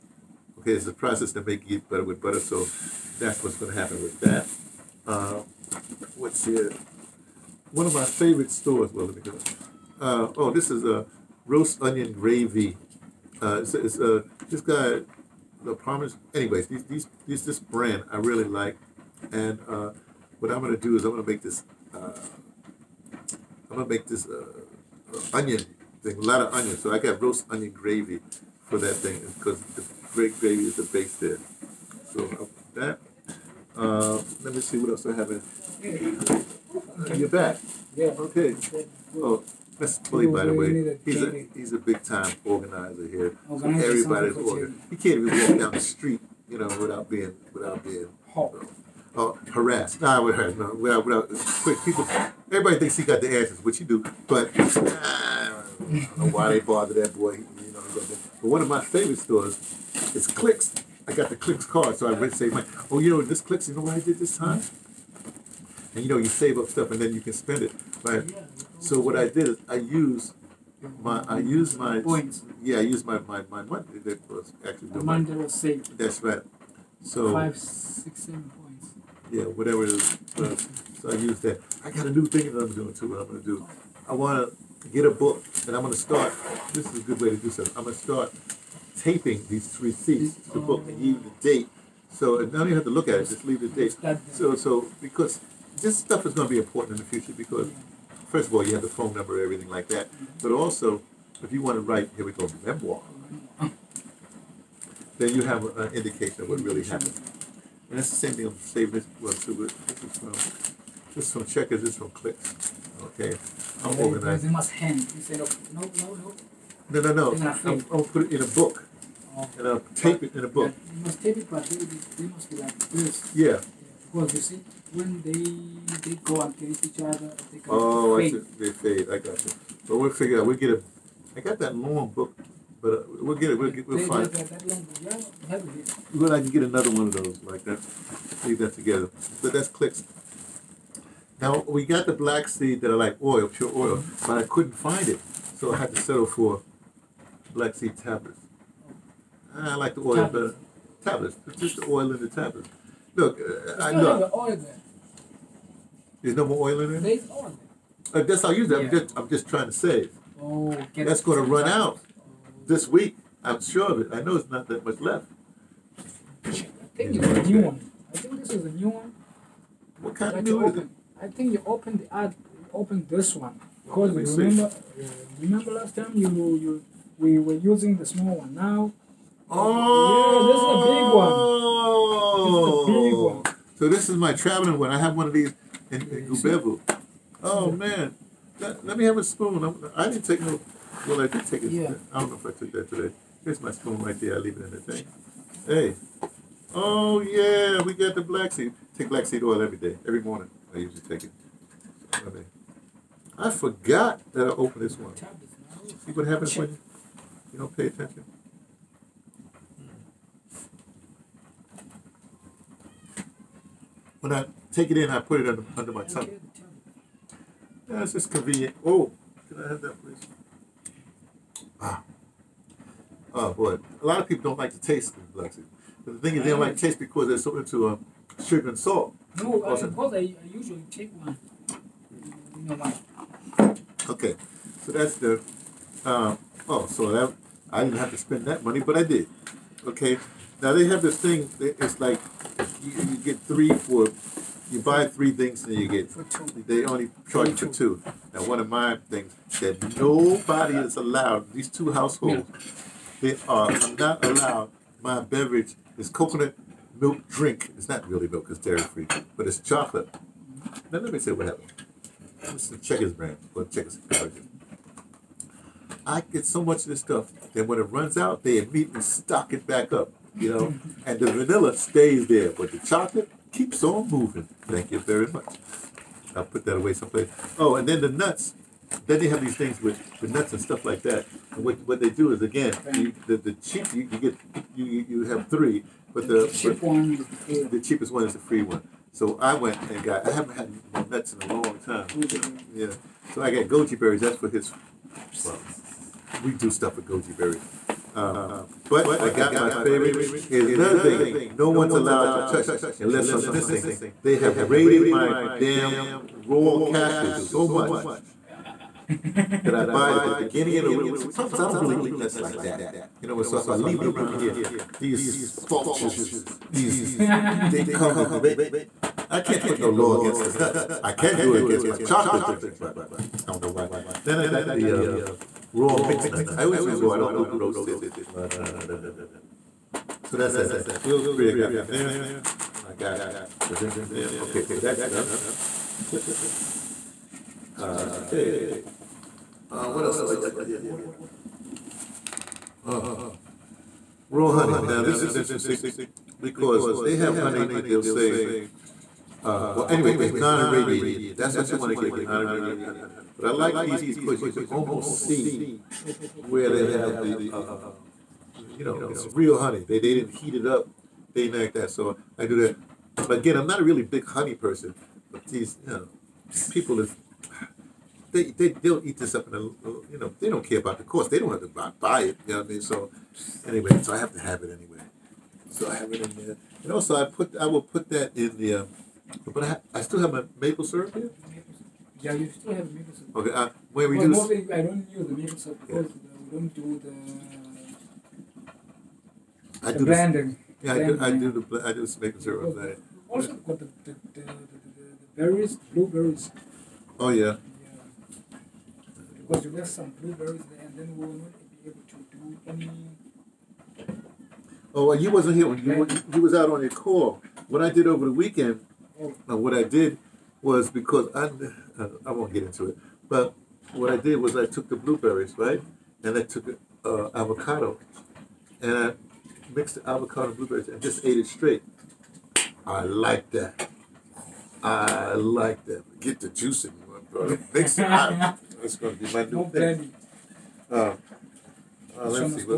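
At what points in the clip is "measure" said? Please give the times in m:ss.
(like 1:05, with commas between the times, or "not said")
not said.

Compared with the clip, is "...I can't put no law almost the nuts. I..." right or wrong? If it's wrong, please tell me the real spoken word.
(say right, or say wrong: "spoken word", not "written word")
wrong: "against", not "almost".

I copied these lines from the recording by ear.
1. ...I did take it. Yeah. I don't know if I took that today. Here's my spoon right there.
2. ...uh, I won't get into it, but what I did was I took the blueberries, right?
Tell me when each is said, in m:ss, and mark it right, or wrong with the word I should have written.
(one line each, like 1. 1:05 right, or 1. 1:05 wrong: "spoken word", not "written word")
1. 3:11 right
2. 6:52 right.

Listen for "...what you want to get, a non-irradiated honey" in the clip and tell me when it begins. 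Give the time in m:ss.
5:51.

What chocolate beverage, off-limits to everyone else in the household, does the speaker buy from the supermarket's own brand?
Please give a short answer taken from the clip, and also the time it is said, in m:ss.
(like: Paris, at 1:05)
Coconut milk drink, at 4:16.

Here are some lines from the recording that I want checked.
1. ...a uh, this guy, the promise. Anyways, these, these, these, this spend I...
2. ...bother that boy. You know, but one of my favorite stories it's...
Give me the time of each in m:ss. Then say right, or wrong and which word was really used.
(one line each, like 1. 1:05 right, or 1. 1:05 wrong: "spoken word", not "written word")
1. 0:13 wrong: "brand", not "spend"
2. 0:56 right.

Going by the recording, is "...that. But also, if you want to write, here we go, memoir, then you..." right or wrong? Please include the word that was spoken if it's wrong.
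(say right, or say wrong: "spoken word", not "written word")
right.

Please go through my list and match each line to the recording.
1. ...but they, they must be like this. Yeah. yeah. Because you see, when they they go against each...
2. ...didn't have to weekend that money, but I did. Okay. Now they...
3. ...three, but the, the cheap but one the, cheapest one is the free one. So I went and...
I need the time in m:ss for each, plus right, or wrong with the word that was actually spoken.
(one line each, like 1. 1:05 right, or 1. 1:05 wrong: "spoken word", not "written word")
1. 2:01 right
2. 3:57 wrong: "spend", not "weekend"
3. 4:45 right.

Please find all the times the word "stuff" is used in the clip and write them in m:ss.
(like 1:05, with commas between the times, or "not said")
1:06, 1:35, 4:26, 4:40, 4:56.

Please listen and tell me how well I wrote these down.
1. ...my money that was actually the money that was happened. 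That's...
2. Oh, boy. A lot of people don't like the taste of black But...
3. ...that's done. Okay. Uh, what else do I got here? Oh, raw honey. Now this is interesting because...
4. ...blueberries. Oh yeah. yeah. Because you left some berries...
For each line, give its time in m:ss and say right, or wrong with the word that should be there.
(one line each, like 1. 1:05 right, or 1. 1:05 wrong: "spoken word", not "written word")
1. 1:13 wrong: "saved", not "happened"
2. 3:43 right
3. 5:34 right
4. 6:35 wrong: "blueberries", not "berries".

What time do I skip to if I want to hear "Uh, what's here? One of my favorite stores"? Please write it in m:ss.
0:05.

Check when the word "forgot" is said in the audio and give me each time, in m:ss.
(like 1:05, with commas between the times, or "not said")
3:23.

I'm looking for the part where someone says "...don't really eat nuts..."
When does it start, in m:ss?
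5:11.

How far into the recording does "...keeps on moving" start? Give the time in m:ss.
4:33.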